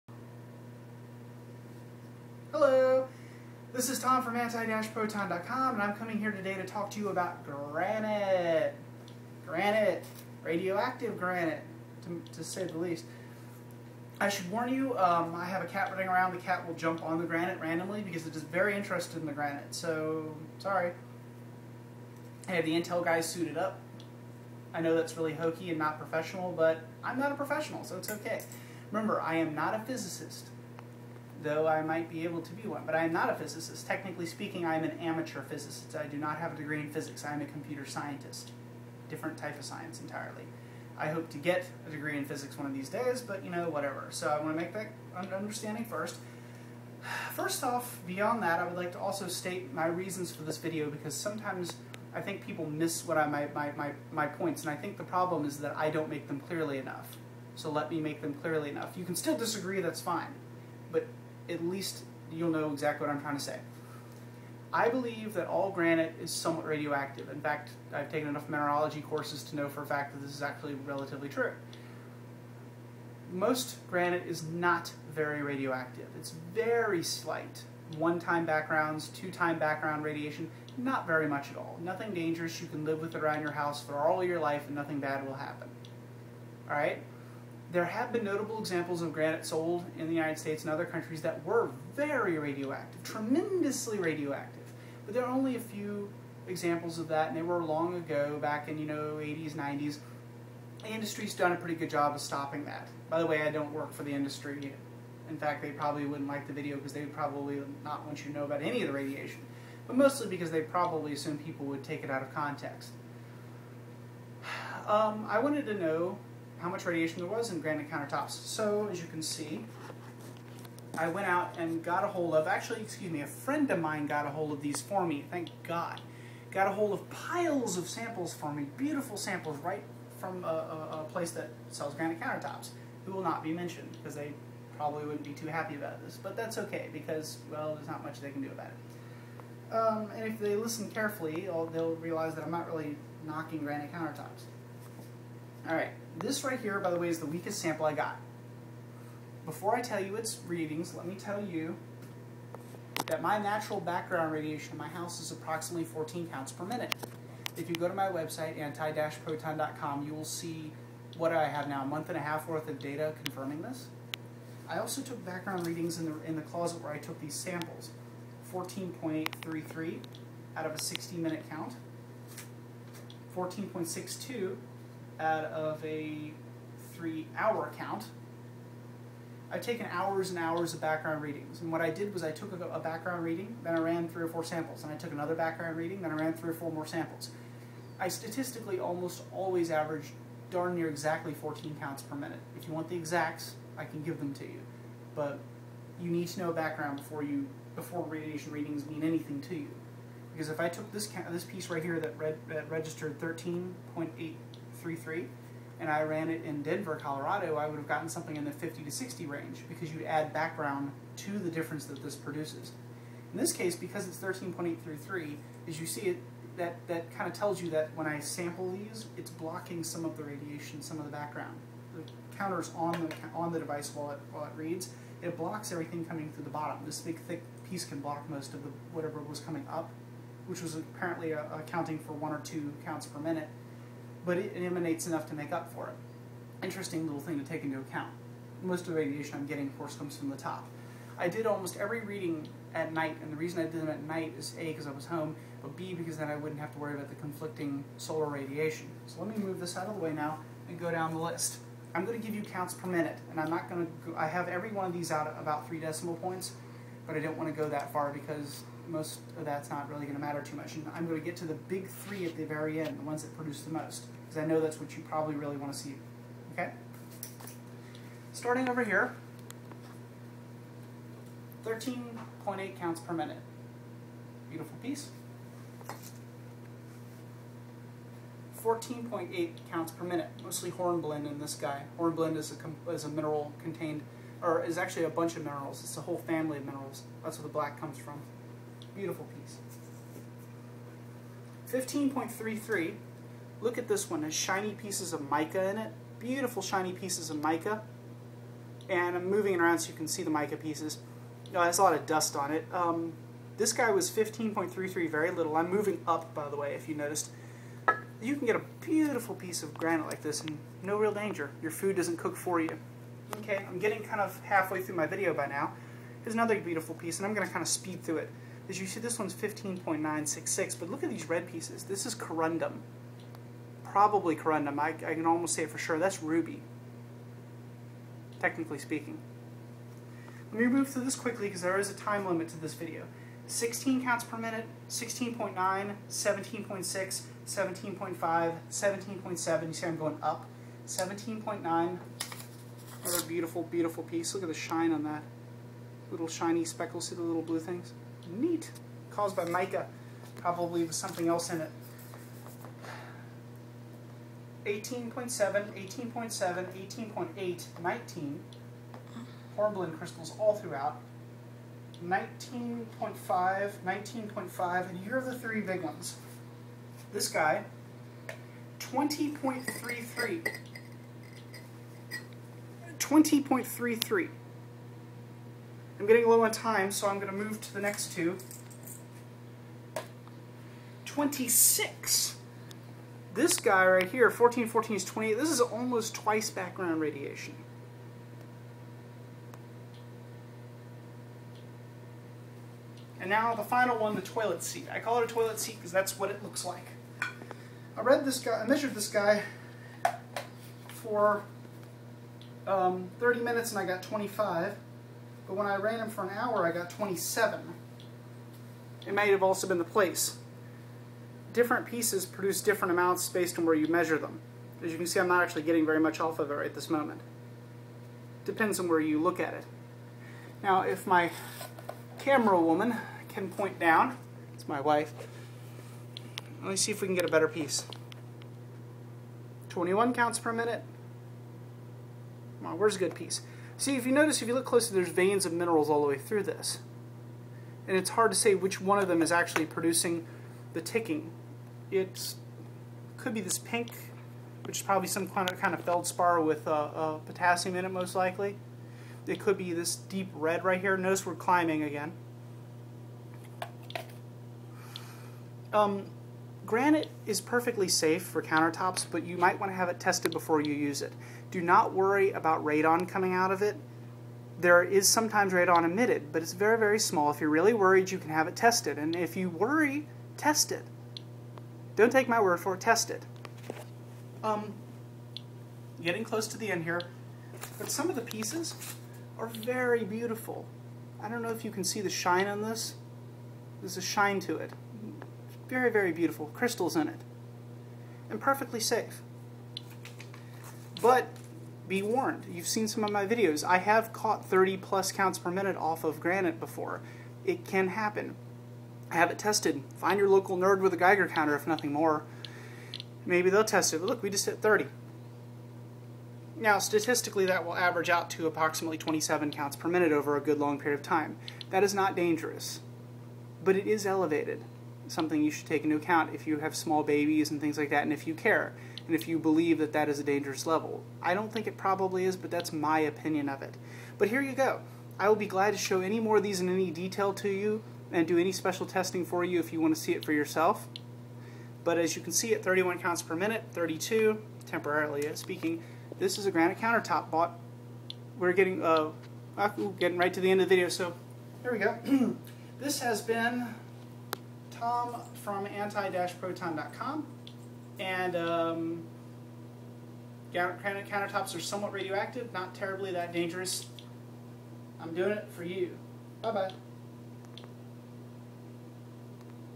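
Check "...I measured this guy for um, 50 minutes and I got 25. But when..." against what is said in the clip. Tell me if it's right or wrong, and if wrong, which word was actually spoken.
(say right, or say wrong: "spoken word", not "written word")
wrong: "30", not "50".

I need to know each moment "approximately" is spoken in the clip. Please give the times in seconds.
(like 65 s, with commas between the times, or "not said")
155 s, 508 s.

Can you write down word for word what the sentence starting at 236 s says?
Interesting little thing to take into account.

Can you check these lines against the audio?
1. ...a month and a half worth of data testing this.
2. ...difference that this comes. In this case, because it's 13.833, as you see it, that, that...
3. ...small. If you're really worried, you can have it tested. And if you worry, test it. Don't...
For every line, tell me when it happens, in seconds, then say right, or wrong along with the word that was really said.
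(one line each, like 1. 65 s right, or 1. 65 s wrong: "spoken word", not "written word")
1. 161 s wrong: "confirming", not "testing"
2. 211 s wrong: "produces", not "comes"
3. 466 s right.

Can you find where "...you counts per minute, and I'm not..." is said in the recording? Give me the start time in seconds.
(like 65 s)
252 s.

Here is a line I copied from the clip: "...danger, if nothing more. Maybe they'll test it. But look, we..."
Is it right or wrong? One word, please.
wrong.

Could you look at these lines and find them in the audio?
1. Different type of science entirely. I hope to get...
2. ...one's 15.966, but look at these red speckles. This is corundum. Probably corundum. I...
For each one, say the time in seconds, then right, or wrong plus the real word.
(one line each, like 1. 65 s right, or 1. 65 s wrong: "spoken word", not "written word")
1. 39 s right
2. 319 s wrong: "pieces", not "speckles".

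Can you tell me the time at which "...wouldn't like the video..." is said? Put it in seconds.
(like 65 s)
106 s.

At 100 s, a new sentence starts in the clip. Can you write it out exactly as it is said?
The industry's done a pretty good job of stopping that.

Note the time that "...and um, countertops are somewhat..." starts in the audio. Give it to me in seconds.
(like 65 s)
547 s.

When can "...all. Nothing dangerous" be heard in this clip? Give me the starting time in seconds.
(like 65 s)
81 s.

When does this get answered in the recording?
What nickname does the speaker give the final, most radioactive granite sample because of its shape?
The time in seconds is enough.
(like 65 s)
394 s.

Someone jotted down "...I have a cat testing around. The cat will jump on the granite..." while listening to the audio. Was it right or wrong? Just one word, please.
wrong.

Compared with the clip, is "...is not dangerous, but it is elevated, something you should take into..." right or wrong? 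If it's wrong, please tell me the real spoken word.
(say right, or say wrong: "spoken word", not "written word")
right.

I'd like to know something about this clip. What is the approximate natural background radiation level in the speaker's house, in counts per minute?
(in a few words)
14.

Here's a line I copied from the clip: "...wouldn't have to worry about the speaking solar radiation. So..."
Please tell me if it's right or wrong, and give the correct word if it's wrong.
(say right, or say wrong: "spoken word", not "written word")
wrong: "conflicting", not "speaking".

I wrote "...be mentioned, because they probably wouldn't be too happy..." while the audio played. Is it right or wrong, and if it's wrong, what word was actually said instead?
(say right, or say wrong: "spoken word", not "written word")
right.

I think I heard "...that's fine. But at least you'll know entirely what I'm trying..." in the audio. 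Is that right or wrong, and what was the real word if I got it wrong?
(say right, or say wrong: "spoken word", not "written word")
wrong: "exactly", not "entirely".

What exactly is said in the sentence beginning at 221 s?
The counter's on the, on the device while it, while it reads.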